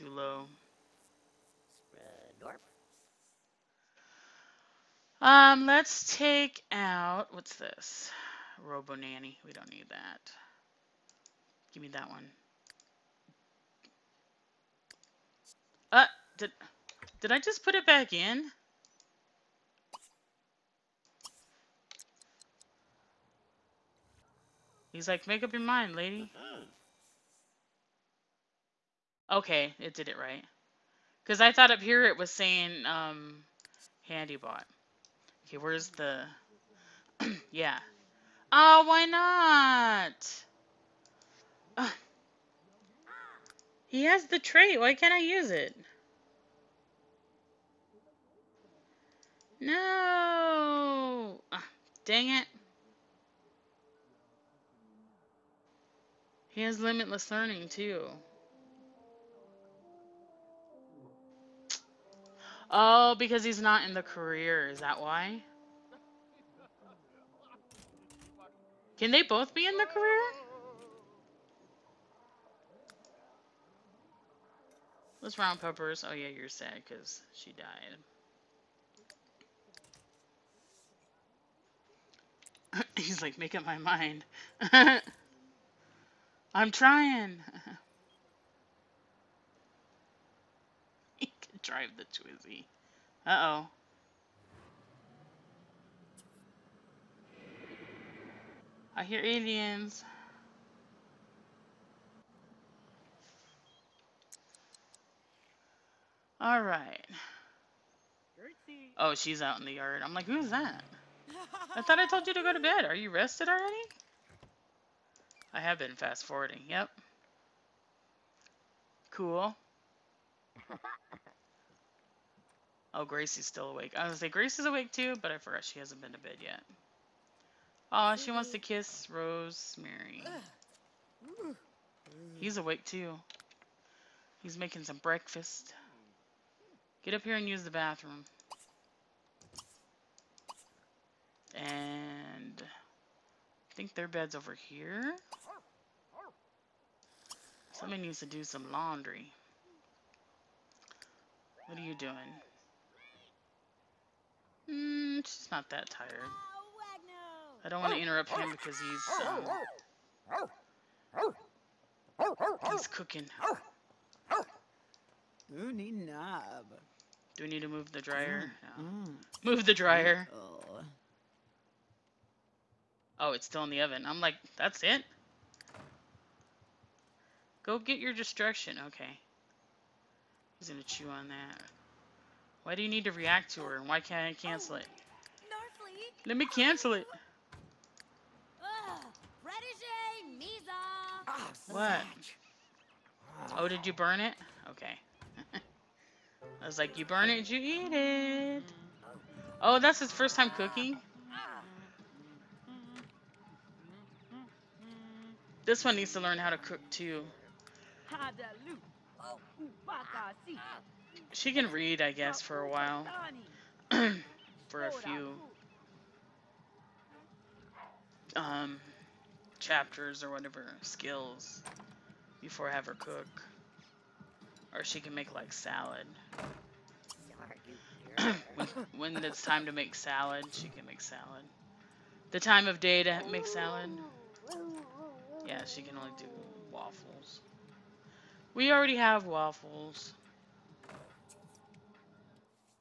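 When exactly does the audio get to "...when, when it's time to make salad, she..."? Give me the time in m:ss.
3:48.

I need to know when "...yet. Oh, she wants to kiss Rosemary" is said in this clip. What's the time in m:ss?
2:06.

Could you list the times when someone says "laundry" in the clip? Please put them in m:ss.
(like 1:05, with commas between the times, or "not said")
2:28.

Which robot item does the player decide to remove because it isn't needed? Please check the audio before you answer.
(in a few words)
Robo nanny.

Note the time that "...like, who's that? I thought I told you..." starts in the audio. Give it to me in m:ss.
1:50.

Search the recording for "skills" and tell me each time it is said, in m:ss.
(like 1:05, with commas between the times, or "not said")
3:40.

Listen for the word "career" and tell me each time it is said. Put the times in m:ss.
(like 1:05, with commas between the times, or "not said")
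1:04, 1:09.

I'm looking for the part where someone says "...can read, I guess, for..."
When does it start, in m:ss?
3:31.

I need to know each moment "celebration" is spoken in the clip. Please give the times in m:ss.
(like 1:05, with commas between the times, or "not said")
not said.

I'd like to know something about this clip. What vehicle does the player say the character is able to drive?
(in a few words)
Twizzy.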